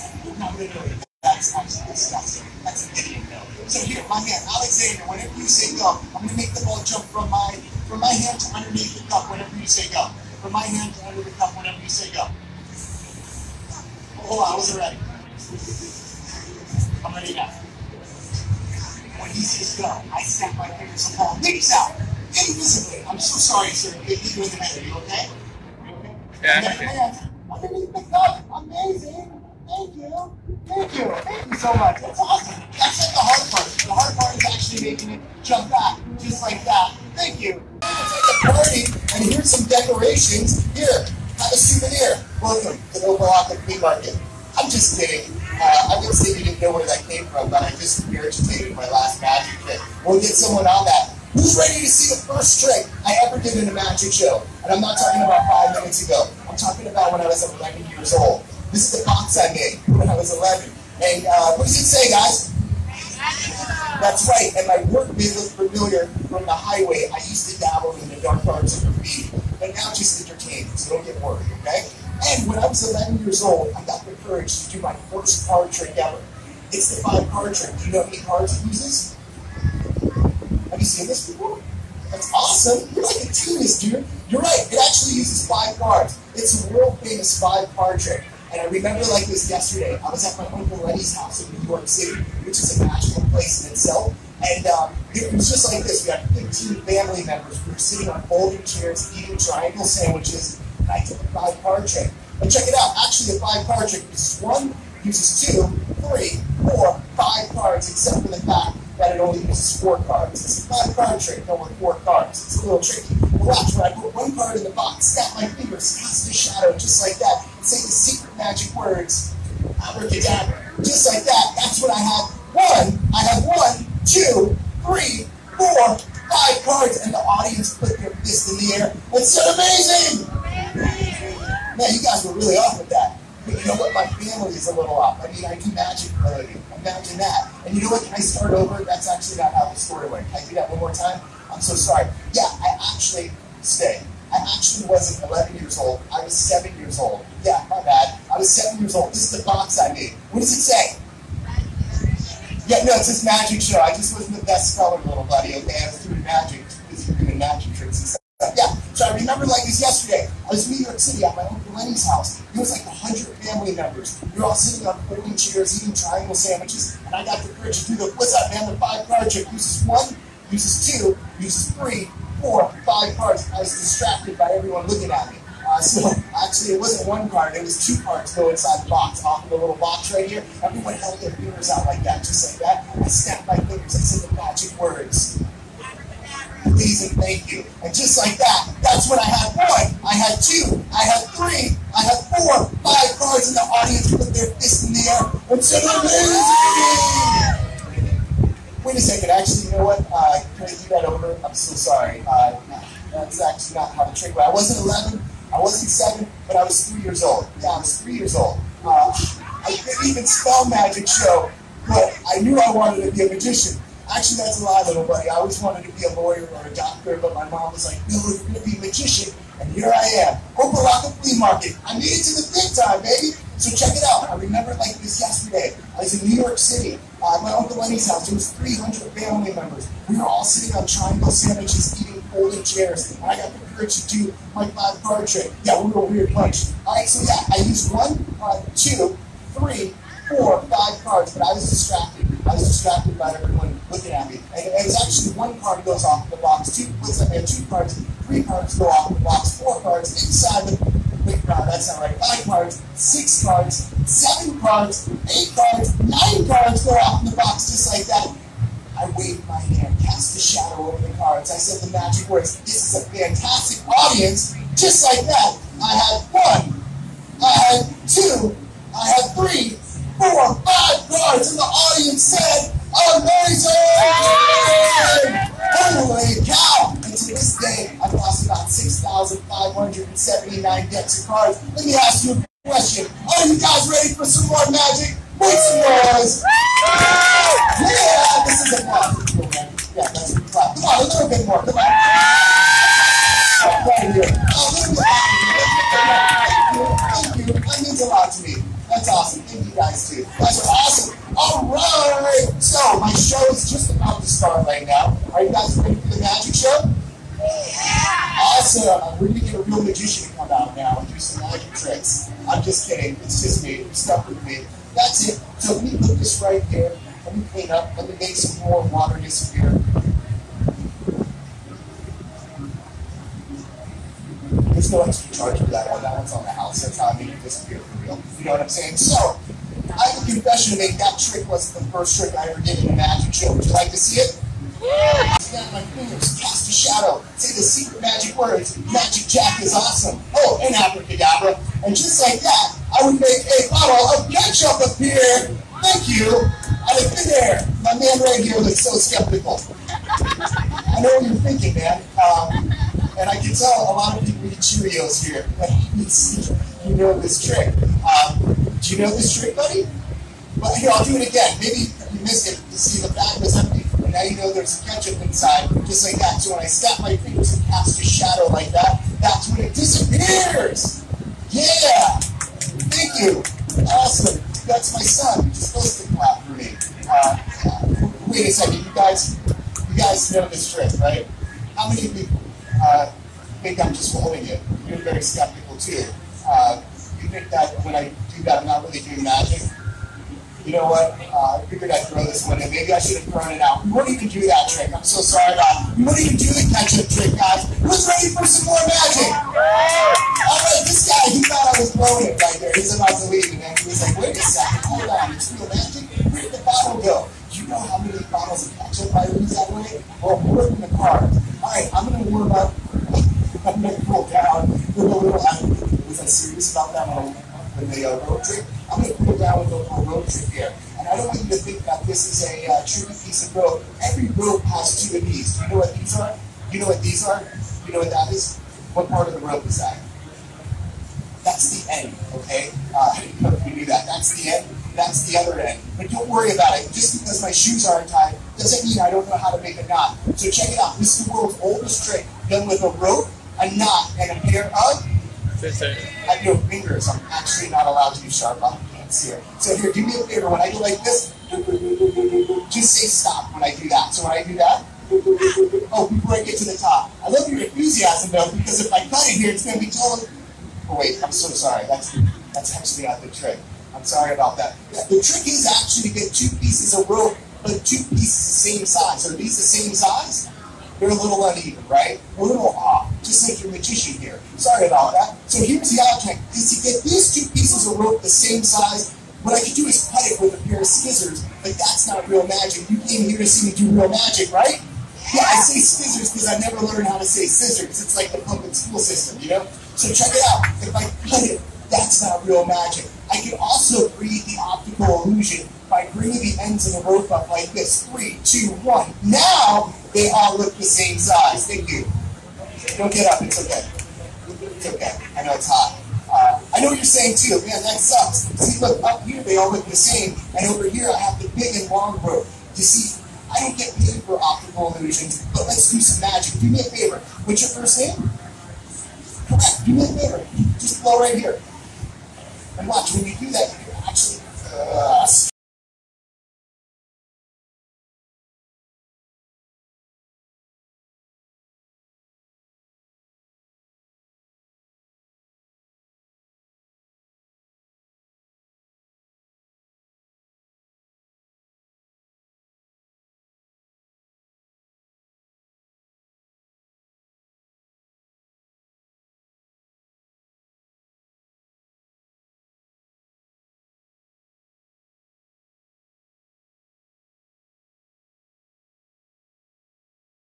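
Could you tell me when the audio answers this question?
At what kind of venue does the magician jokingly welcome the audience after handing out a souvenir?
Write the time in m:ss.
0:43.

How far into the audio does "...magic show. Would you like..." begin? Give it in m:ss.
5:32.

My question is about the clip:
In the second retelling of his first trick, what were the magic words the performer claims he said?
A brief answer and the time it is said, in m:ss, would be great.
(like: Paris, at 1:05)
please and thank you, at 3:06.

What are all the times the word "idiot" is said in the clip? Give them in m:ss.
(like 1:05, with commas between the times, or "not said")
0:02.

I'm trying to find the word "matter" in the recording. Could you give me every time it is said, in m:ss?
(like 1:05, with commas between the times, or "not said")
0:24.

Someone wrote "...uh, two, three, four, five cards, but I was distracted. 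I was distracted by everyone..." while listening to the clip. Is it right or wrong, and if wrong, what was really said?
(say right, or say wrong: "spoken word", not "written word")
right.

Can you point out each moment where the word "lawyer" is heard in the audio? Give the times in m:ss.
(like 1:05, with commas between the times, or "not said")
3:36.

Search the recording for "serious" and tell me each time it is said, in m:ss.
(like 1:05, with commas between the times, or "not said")
6:56.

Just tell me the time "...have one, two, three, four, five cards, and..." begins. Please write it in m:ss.
2:03.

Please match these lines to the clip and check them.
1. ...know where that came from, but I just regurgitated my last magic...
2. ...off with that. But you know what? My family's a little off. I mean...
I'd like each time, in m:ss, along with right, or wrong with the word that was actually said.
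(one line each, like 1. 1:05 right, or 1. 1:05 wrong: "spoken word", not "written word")
1. 0:46 right
2. 2:12 right.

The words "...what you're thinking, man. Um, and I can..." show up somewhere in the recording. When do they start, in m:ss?
5:51.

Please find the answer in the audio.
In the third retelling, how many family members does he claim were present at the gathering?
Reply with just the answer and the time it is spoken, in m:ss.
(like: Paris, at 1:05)
300, at 3:48.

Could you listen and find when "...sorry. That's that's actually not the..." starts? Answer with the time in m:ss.
7:41.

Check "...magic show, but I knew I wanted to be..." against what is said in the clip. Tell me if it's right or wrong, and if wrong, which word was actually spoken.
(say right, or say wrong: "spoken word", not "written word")
right.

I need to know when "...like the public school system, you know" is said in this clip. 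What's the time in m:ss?
8:08.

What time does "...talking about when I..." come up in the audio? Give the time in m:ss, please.
0:56.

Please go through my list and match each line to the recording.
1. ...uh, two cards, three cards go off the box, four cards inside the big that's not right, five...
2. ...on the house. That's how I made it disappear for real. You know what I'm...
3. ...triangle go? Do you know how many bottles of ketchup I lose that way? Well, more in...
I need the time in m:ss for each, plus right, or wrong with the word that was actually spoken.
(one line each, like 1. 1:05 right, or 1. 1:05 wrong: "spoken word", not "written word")
1. 4:06 right
2. 5:26 right
3. 6:46 wrong: "bottle", not "triangle".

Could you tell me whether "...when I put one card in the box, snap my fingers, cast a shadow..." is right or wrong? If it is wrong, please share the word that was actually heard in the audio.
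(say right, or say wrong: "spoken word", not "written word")
right.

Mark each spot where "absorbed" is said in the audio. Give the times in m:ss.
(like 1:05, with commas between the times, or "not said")
not said.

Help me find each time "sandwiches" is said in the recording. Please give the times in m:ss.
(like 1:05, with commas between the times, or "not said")
1:39, 2:46, 3:51.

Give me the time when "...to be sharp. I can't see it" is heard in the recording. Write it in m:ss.
7:28.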